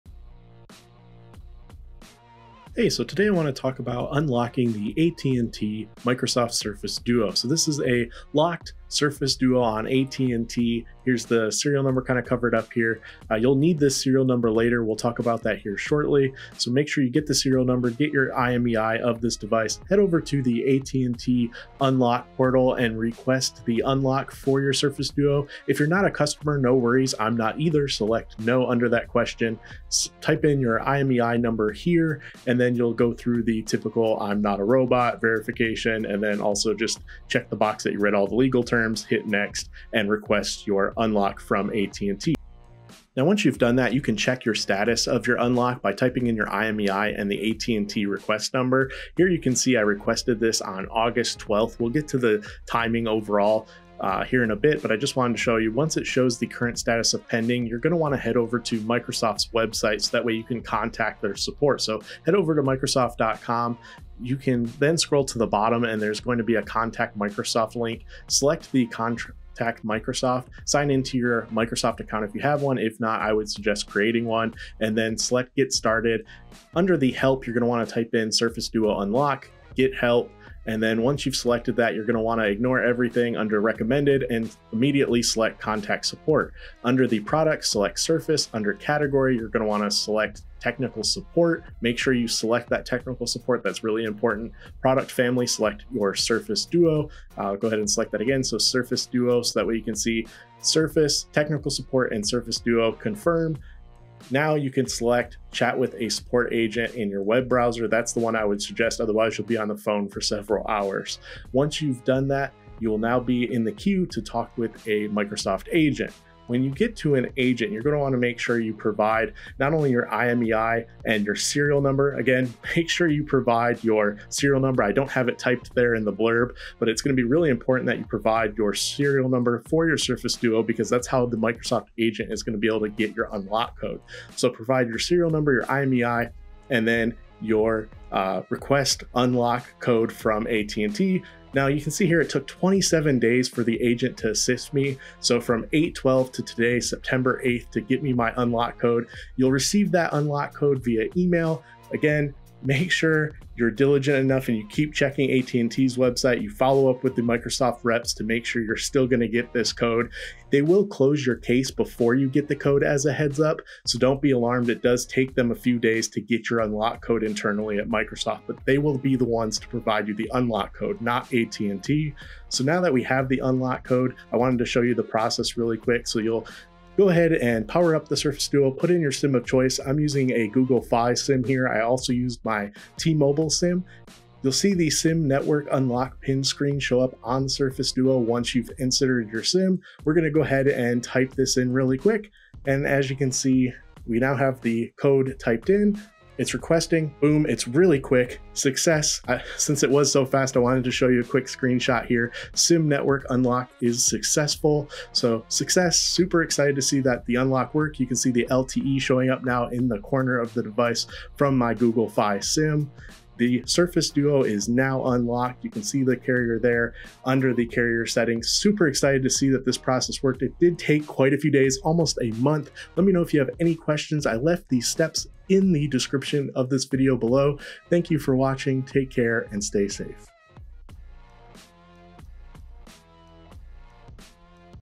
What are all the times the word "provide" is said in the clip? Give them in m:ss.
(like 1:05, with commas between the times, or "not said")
1:58, 2:03, 2:08, 2:14, 2:49.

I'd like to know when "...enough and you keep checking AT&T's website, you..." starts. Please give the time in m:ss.
2:34.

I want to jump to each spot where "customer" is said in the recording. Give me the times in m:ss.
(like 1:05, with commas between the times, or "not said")
0:26.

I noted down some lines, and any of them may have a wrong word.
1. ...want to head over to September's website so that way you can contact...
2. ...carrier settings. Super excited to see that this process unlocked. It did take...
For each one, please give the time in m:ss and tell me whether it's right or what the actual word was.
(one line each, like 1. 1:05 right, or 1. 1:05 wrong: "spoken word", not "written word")
1. 0:57 wrong: "Microsoft", not "September"
2. 3:37 wrong: "worked", not "unlocked".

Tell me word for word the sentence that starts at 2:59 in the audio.
I'm using a Google Fi SIM here.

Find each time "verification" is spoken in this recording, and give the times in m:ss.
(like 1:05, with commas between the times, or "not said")
0:35.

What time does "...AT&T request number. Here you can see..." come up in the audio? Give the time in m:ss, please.
0:47.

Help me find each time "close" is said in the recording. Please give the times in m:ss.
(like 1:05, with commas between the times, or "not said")
2:40.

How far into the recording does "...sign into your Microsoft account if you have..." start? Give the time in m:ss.
1:10.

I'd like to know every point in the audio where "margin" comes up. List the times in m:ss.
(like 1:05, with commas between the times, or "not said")
not said.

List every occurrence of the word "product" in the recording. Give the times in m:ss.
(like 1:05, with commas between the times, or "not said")
1:27, 1:34.